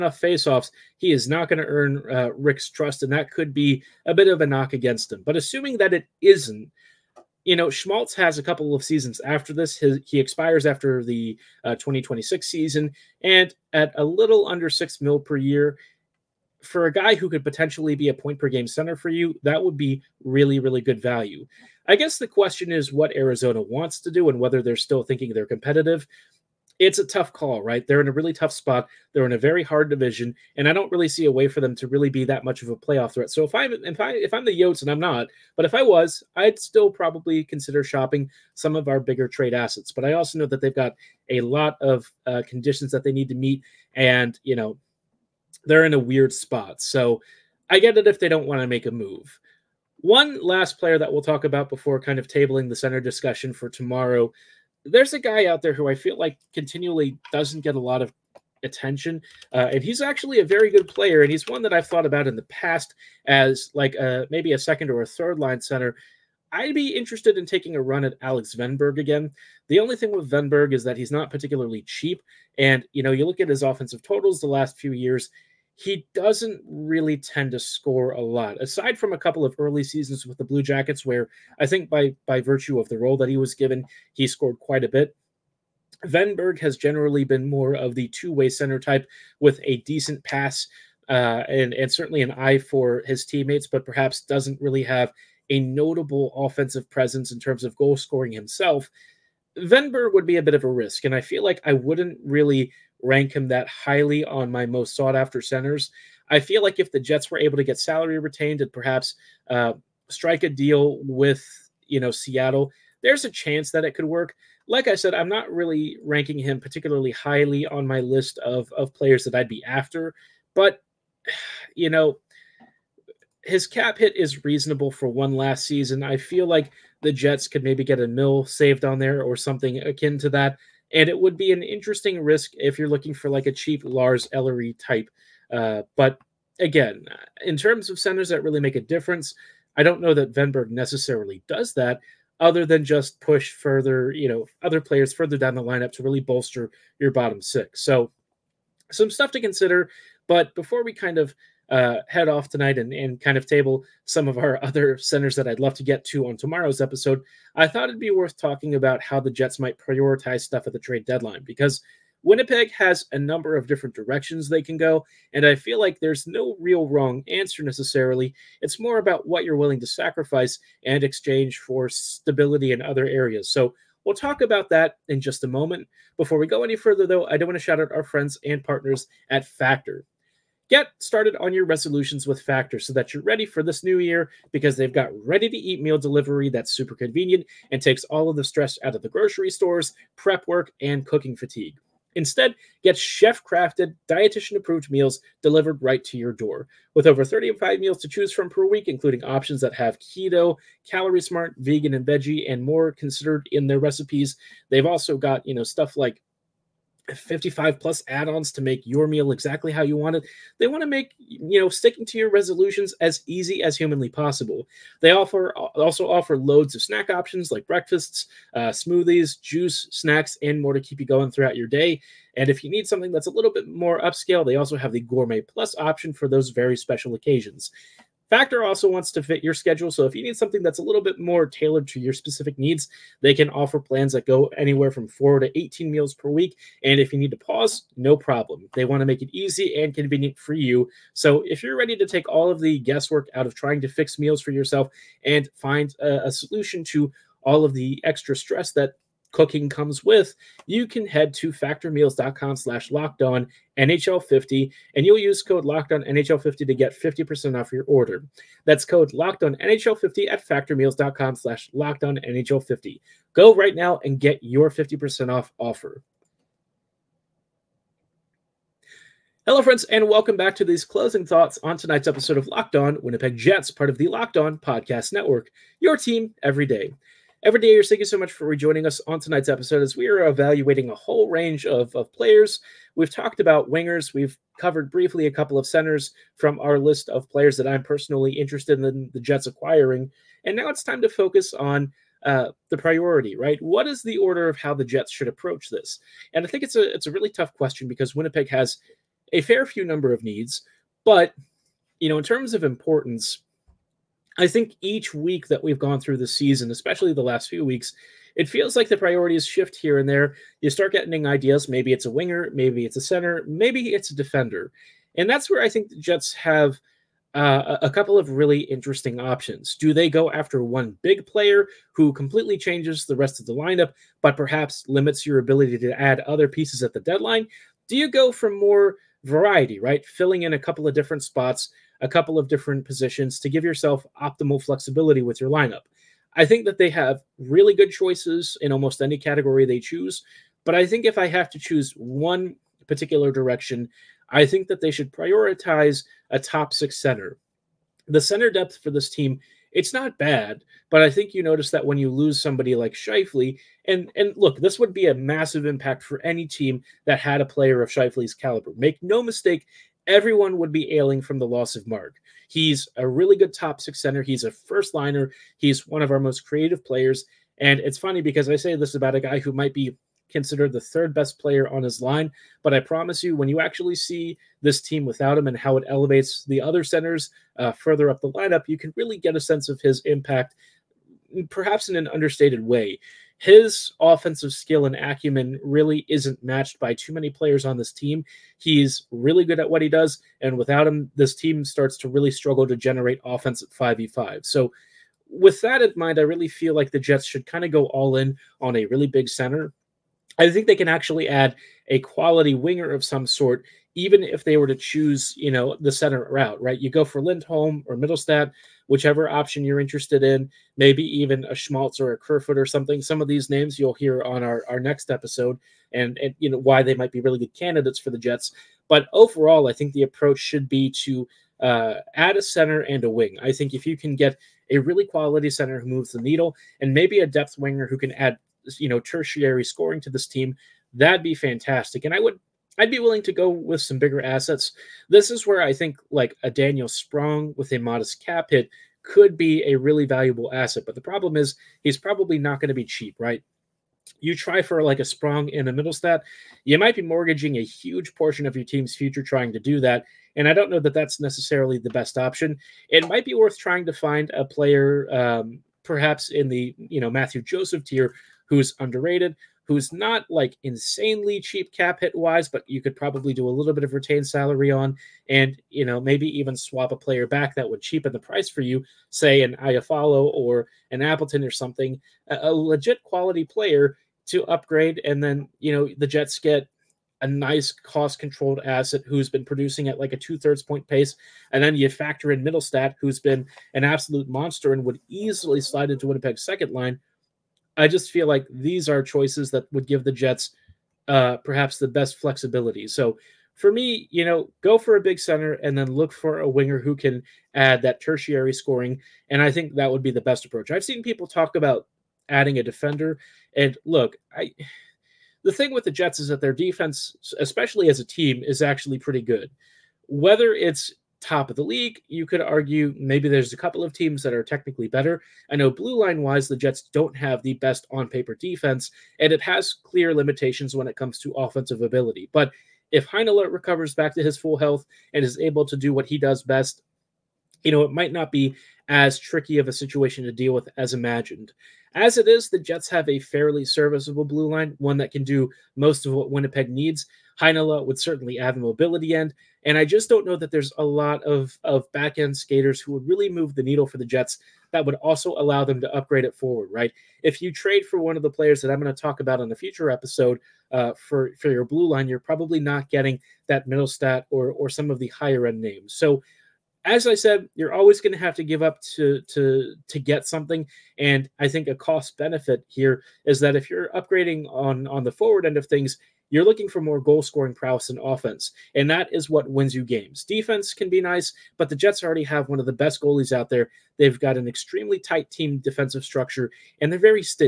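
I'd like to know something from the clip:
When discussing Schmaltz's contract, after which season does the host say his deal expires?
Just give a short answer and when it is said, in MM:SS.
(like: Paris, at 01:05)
2026, at 00:11.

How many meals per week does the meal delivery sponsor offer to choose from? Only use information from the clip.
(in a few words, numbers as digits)
35.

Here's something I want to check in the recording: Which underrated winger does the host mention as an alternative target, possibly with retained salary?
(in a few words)
Mathieu Joseph.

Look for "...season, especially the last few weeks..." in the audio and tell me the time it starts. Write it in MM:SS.
05:06.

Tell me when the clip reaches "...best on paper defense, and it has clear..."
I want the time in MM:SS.
08:37.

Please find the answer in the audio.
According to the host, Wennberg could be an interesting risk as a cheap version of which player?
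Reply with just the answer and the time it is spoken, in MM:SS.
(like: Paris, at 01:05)
Lars Ellery, at 02:13.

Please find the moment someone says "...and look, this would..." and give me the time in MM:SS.
05:54.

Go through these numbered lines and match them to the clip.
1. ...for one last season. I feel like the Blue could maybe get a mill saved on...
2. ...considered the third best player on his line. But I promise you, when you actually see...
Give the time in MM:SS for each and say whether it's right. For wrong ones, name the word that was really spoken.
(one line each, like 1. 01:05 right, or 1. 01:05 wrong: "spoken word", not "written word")
1. 02:04 wrong: "Jets", not "Blue"
2. 06:10 right.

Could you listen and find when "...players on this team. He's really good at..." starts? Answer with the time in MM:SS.
06:27.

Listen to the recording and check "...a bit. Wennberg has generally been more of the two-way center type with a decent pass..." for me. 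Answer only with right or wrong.
right.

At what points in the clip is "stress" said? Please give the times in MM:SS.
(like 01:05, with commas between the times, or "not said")
03:08, 04:08.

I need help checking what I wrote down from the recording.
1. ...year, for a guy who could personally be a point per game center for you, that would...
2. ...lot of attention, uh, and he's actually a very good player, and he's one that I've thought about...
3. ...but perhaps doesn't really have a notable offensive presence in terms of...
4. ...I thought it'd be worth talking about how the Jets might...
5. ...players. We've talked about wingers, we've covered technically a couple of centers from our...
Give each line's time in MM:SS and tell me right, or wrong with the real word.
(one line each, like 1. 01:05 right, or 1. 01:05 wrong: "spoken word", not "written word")
1. 00:15 wrong: "potentially", not "personally"
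2. 00:57 right
3. 01:33 right
4. 02:37 right
5. 04:42 wrong: "briefly", not "technically".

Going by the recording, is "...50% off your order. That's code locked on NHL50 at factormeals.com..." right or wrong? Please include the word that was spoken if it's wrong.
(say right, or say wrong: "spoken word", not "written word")
right.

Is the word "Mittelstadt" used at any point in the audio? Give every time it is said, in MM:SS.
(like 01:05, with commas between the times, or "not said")
06:47, 07:25, 08:02, 09:13.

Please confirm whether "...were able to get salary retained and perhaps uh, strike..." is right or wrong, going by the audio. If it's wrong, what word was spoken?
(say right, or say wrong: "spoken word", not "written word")
right.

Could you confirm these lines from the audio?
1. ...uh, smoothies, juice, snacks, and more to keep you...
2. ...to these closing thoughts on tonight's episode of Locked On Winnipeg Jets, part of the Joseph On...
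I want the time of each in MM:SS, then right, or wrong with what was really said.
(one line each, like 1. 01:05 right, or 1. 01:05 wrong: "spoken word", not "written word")
1. 03:38 right
2. 04:30 wrong: "Locked", not "Joseph".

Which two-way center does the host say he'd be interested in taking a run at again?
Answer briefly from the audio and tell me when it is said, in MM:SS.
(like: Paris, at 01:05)
Alex Wennberg, at 01:08.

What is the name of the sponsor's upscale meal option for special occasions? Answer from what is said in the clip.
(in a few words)
Gourmet Plus.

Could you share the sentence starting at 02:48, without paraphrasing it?
It's more about what you're willing to sacrifice and exchange for stability in other areas.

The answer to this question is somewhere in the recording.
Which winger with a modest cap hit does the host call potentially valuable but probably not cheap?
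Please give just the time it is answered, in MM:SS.
07:16.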